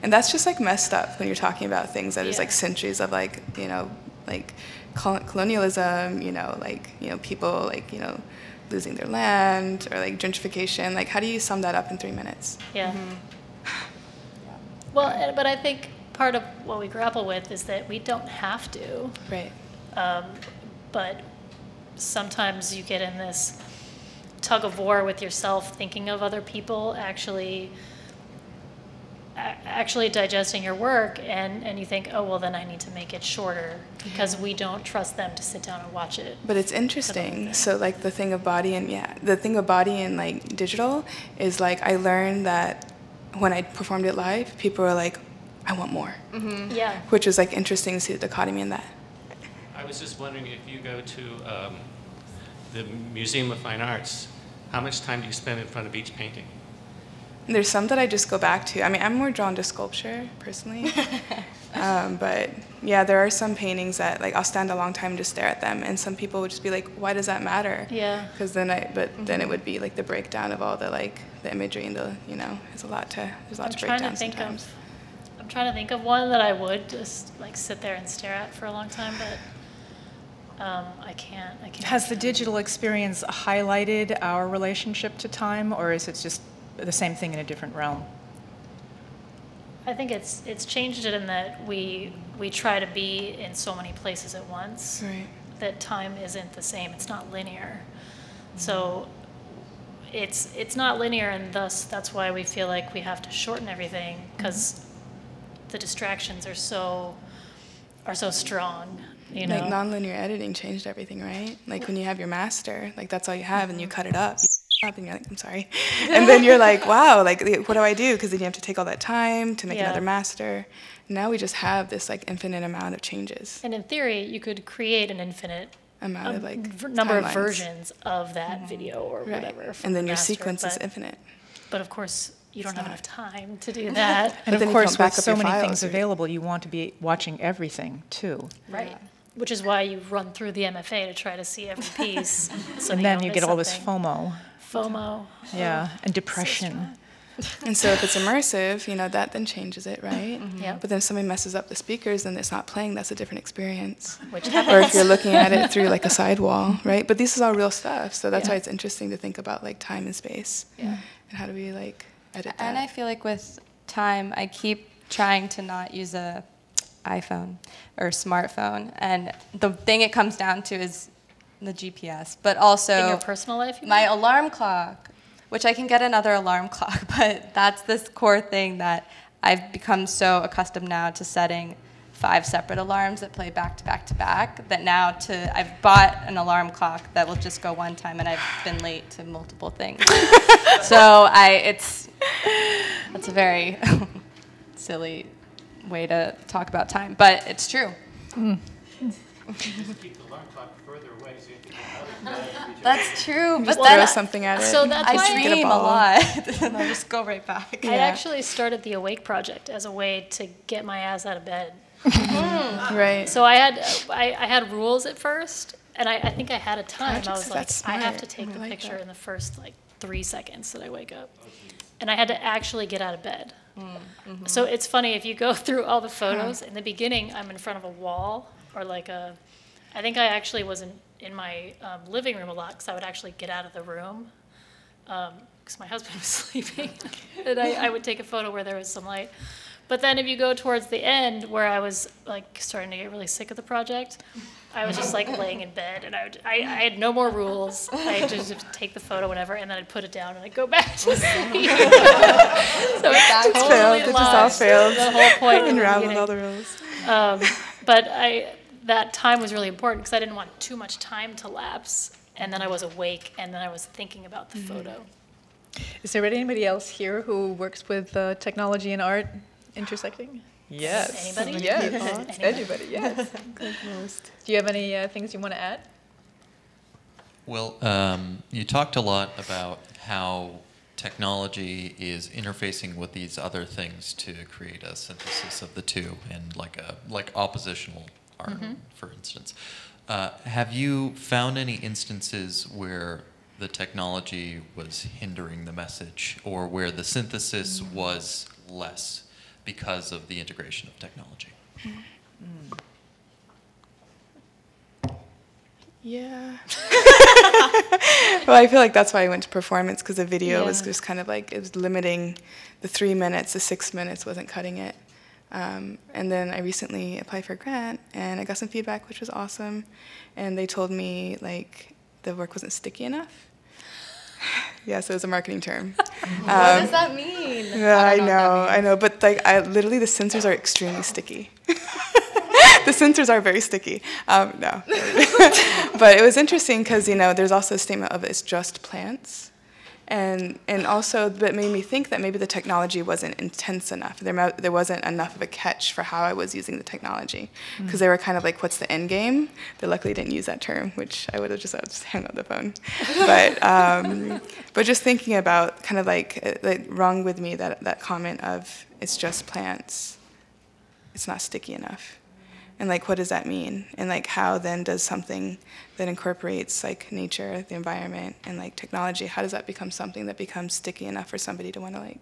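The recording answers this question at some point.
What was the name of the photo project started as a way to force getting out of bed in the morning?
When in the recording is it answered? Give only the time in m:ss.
3:28.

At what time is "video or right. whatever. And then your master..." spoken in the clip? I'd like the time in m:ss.
2:08.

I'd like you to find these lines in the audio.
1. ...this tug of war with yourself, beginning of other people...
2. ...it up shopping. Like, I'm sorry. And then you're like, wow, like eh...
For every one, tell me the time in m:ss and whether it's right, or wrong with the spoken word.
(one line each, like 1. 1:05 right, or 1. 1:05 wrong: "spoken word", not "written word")
1. 0:23 wrong: "thinking", not "beginning"
2. 1:54 right.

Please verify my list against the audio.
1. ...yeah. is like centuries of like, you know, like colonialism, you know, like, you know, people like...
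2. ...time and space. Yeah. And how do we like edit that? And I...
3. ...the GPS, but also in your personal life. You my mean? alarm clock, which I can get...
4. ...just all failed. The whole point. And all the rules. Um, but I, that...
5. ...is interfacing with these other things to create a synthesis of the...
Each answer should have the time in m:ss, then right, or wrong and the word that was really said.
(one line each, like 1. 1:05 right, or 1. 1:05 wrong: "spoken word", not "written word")
1. 0:02 right
2. 2:39 right
3. 2:51 right
4. 4:14 right
5. 4:42 right.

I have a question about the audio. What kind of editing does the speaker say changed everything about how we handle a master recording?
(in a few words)
Nonlinear editing.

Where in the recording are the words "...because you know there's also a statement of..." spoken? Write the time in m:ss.
5:36.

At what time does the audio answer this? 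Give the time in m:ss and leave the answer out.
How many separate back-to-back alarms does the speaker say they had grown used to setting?
3:02.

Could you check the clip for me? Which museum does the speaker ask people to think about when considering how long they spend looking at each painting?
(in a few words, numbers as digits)
Museum of Fine Arts.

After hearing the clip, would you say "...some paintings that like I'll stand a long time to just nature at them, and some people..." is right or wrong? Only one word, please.
wrong.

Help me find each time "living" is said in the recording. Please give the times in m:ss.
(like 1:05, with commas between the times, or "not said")
3:52.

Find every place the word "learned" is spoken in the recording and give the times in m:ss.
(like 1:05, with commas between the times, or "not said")
0:41.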